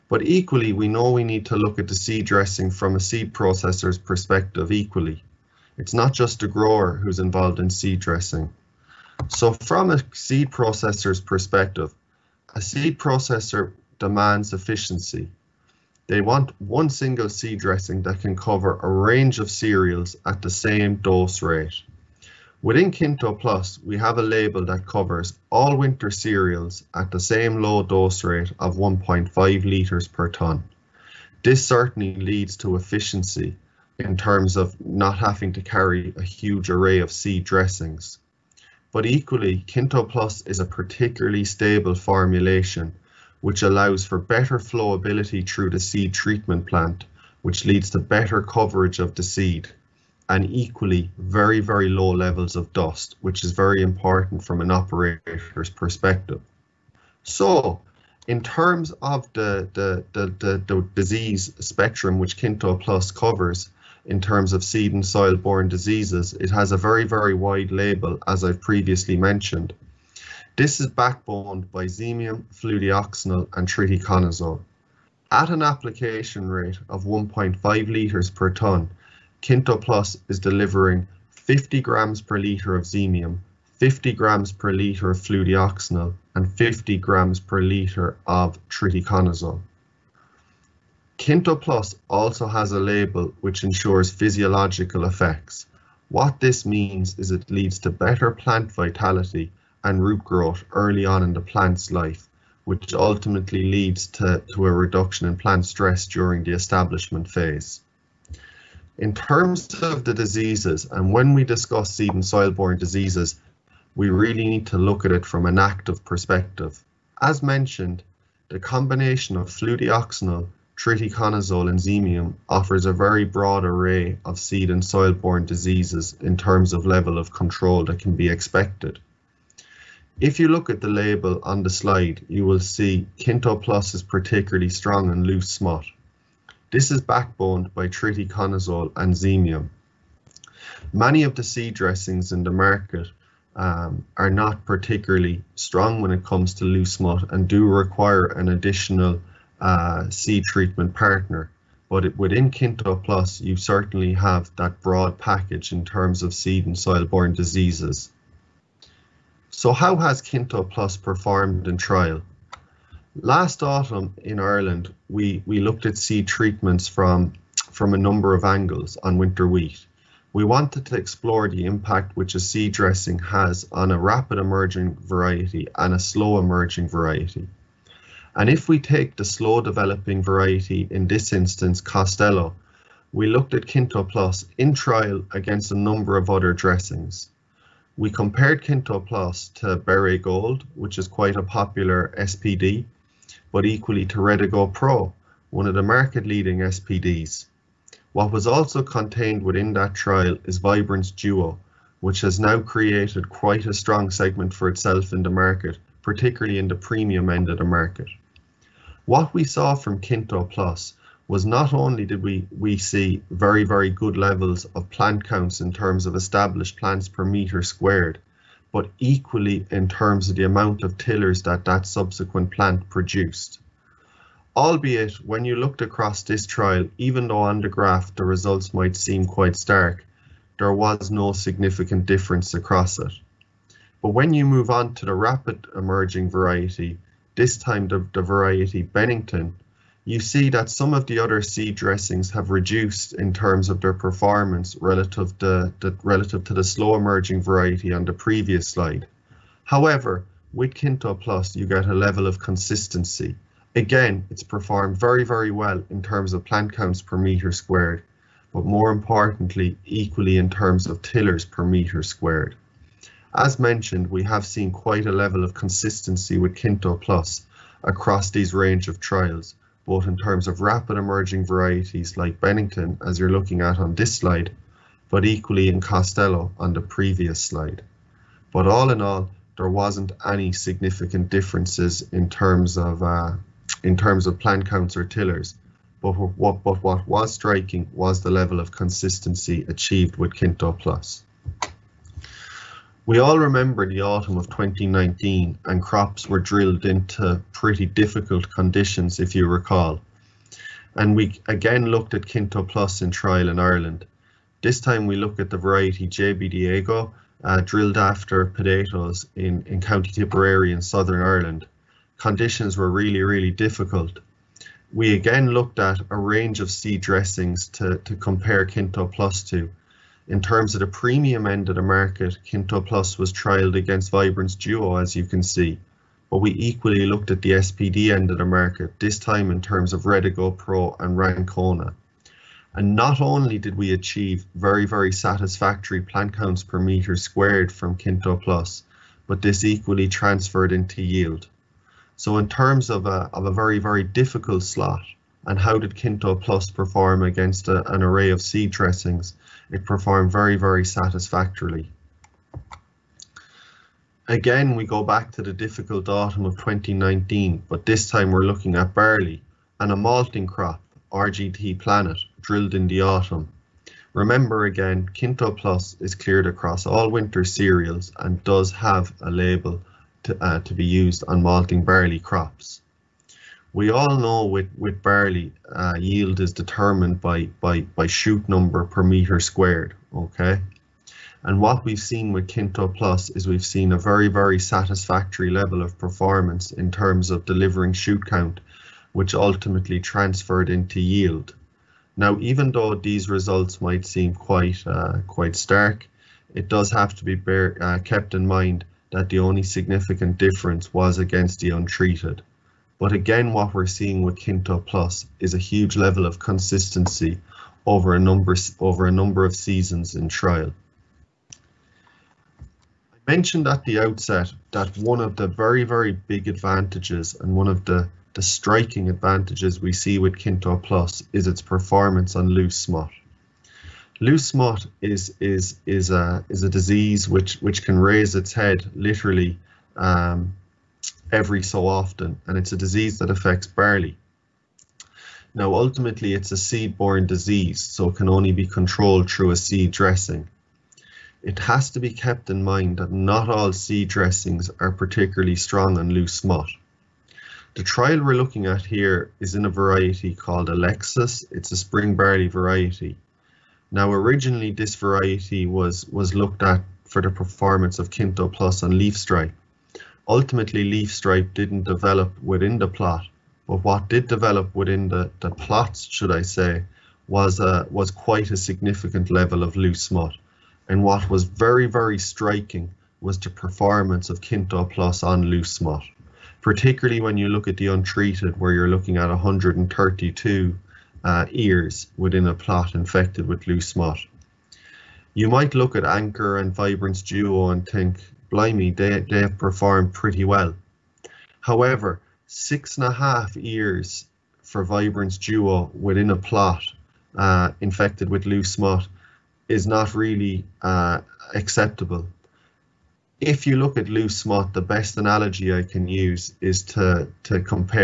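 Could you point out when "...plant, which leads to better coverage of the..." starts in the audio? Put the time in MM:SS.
00:46.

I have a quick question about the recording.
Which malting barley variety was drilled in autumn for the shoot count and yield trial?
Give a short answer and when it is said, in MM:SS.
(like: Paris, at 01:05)
RGT Planet, at 06:01.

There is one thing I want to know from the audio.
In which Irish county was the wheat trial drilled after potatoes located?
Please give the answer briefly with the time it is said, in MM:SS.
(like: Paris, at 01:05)
Tipperary, at 05:09.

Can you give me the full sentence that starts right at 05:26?
But we equally looked at the SPD end of the market, this time in terms of Redigo Pro and Rancona.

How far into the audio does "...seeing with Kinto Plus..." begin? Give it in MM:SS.
06:43.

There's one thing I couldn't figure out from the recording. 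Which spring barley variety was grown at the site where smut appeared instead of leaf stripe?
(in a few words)
Alexis.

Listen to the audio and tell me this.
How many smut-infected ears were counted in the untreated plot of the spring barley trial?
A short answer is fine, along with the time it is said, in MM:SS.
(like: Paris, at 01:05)
132, at 07:59.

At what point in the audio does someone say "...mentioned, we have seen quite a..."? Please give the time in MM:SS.
04:23.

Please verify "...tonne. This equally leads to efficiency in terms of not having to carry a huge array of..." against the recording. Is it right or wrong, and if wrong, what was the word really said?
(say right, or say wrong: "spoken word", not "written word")
wrong: "certainly", not "equally".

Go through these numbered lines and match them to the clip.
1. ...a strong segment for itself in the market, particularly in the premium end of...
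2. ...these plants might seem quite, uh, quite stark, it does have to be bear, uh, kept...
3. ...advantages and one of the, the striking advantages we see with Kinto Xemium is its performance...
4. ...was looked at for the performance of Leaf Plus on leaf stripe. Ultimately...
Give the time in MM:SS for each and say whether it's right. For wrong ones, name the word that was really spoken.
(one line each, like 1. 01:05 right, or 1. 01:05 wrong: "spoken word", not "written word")
1. 03:23 right
2. 06:32 wrong: "results", not "plants"
3. 06:56 wrong: "Plus", not "Xemium"
4. 07:36 wrong: "Kinto", not "Leaf".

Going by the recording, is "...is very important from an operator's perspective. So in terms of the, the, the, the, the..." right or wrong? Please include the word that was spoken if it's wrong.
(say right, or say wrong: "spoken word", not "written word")
right.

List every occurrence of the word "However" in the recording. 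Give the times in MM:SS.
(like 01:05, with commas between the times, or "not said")
04:09, 08:11.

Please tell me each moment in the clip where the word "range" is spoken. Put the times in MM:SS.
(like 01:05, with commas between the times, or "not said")
00:18, 04:28, 05:16.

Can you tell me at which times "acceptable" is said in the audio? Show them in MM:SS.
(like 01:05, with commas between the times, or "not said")
08:21.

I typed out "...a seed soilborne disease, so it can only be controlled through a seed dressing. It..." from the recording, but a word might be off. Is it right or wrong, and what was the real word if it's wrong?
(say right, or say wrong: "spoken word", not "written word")
wrong: "borne", not "soilborne".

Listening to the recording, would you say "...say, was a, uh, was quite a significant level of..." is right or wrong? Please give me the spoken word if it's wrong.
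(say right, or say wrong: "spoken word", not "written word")
right.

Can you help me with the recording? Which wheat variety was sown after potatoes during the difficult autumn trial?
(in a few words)
JB Diego.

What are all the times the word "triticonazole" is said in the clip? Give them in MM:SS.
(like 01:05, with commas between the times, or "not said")
01:13, 01:28, 02:00, 02:17.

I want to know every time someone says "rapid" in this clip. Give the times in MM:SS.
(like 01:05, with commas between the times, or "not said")
02:53, 03:55, 04:30.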